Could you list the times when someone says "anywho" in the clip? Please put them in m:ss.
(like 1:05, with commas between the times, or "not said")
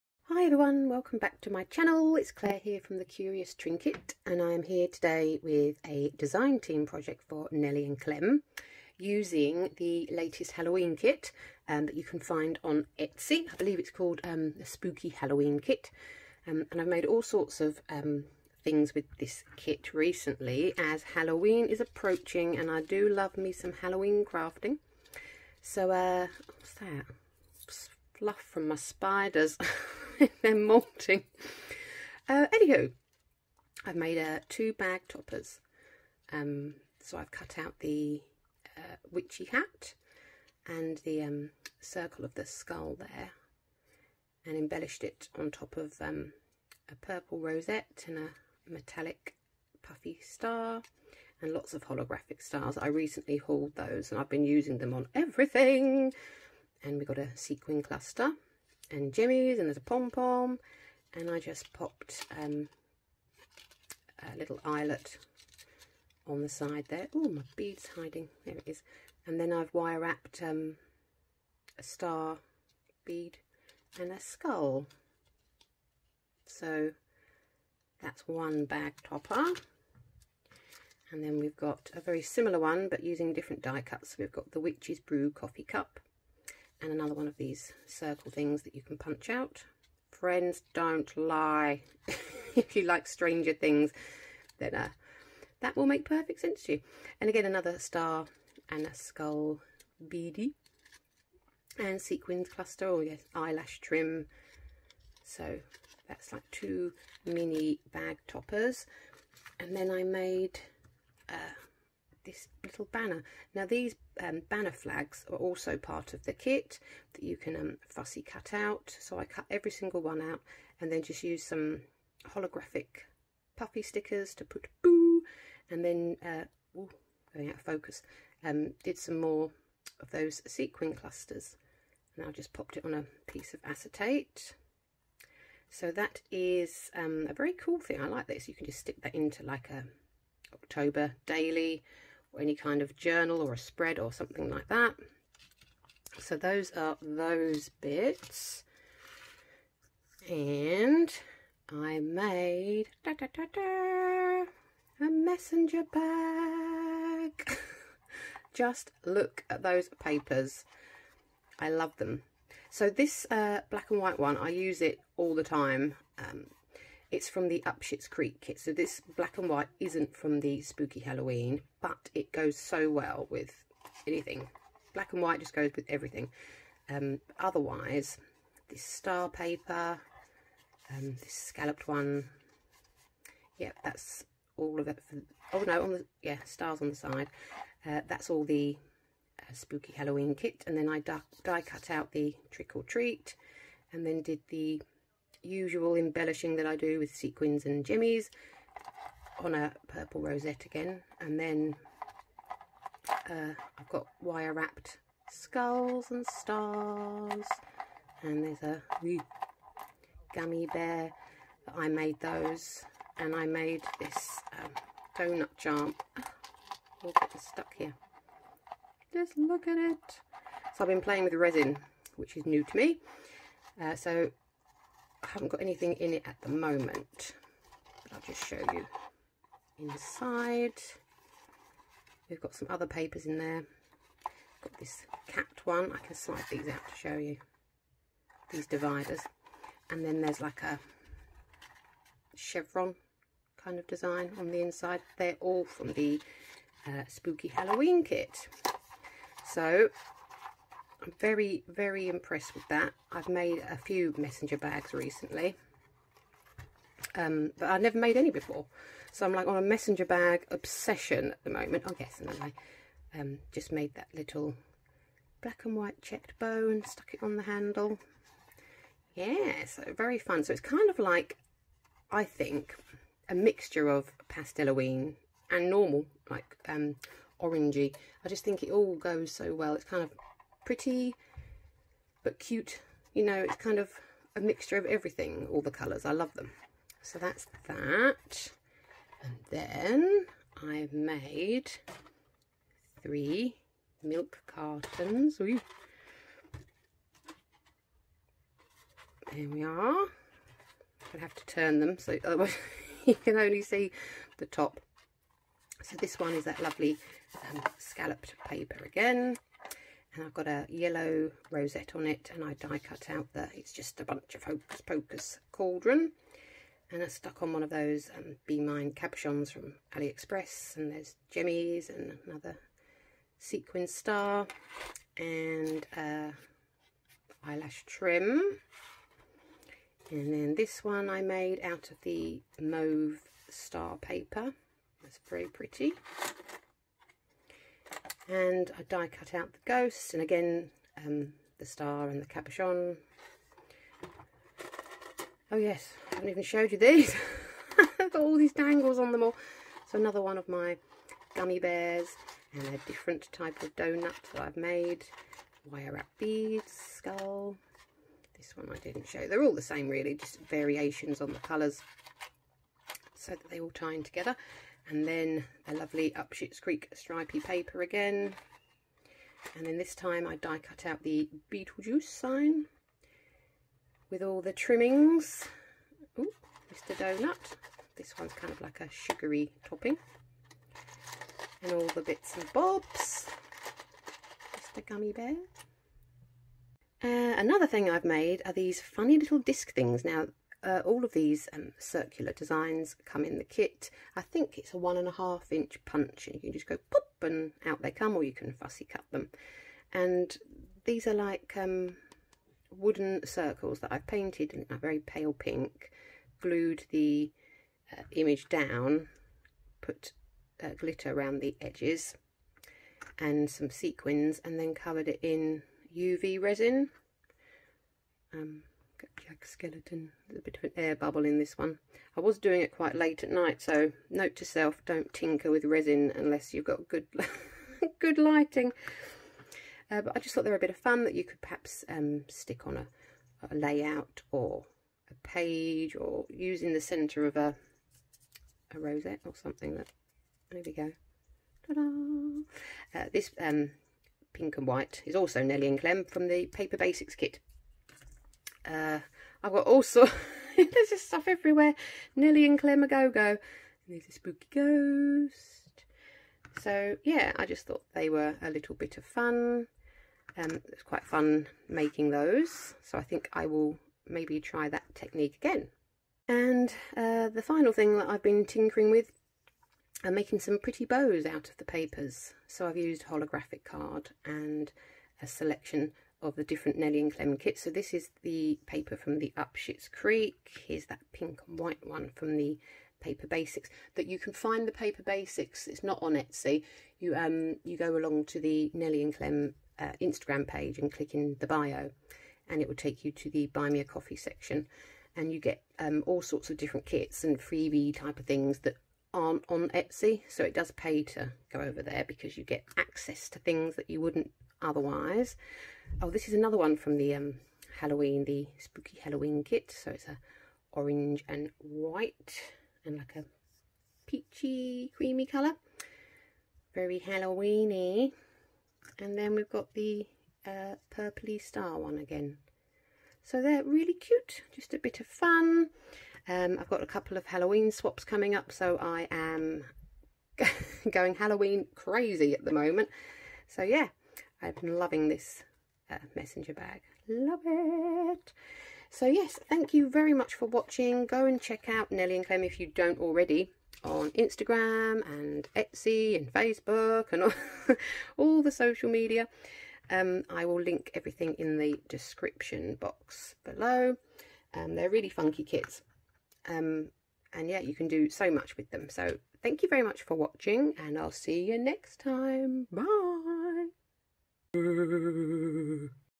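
0:32.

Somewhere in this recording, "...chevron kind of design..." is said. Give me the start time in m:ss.
4:02.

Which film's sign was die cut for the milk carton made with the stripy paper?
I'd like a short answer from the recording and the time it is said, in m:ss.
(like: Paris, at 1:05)
Beetlejuice, at 6:11.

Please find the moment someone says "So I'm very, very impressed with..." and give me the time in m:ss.
4:09.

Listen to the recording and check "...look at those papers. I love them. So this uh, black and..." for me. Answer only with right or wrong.
right.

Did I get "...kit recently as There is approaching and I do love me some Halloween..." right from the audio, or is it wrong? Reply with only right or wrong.
wrong.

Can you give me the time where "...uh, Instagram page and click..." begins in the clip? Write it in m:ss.
8:09.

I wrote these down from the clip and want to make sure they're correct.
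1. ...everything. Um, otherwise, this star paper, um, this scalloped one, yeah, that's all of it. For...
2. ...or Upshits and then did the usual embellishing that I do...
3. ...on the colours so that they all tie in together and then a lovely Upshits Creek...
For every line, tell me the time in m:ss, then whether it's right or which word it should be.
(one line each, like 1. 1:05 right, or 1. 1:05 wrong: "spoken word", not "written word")
1. 2:55 right
2. 3:12 wrong: "Treat", not "Upshits"
3. 6:01 right.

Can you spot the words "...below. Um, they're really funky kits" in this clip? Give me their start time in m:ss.
9:13.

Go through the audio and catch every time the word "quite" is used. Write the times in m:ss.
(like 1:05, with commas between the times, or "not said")
7:02, 7:40.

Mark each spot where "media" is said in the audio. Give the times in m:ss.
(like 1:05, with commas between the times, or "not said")
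9:08.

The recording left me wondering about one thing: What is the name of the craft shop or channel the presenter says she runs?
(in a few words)
The Curious Trinket.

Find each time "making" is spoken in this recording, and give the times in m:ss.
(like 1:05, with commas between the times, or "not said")
7:41, 7:50.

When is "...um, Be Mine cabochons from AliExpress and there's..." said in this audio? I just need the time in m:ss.
5:18.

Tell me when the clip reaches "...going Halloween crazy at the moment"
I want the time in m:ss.
8:50.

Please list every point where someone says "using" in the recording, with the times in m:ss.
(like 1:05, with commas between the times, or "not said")
0:08, 0:54, 1:23, 7:16.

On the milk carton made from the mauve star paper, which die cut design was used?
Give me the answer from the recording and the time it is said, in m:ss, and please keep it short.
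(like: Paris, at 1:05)
ghosts, at 5:39.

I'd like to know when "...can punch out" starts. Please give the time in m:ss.
1:28.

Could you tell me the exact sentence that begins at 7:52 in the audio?
So I've used holographic card and a selection of the different Nelly and Clem kits.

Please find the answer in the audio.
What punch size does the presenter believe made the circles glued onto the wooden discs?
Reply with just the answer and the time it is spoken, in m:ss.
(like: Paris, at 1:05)
1.5 inch, at 6:34.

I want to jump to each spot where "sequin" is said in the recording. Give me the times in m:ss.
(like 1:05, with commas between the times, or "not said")
0:57, 1:42, 2:10, 3:17, 5:23, 6:53.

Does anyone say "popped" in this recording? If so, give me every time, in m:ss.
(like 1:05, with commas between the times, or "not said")
1:01, 2:12.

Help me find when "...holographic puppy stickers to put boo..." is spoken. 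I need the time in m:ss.
2:02.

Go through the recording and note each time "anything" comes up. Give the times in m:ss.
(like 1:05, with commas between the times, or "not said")
2:54, 3:45.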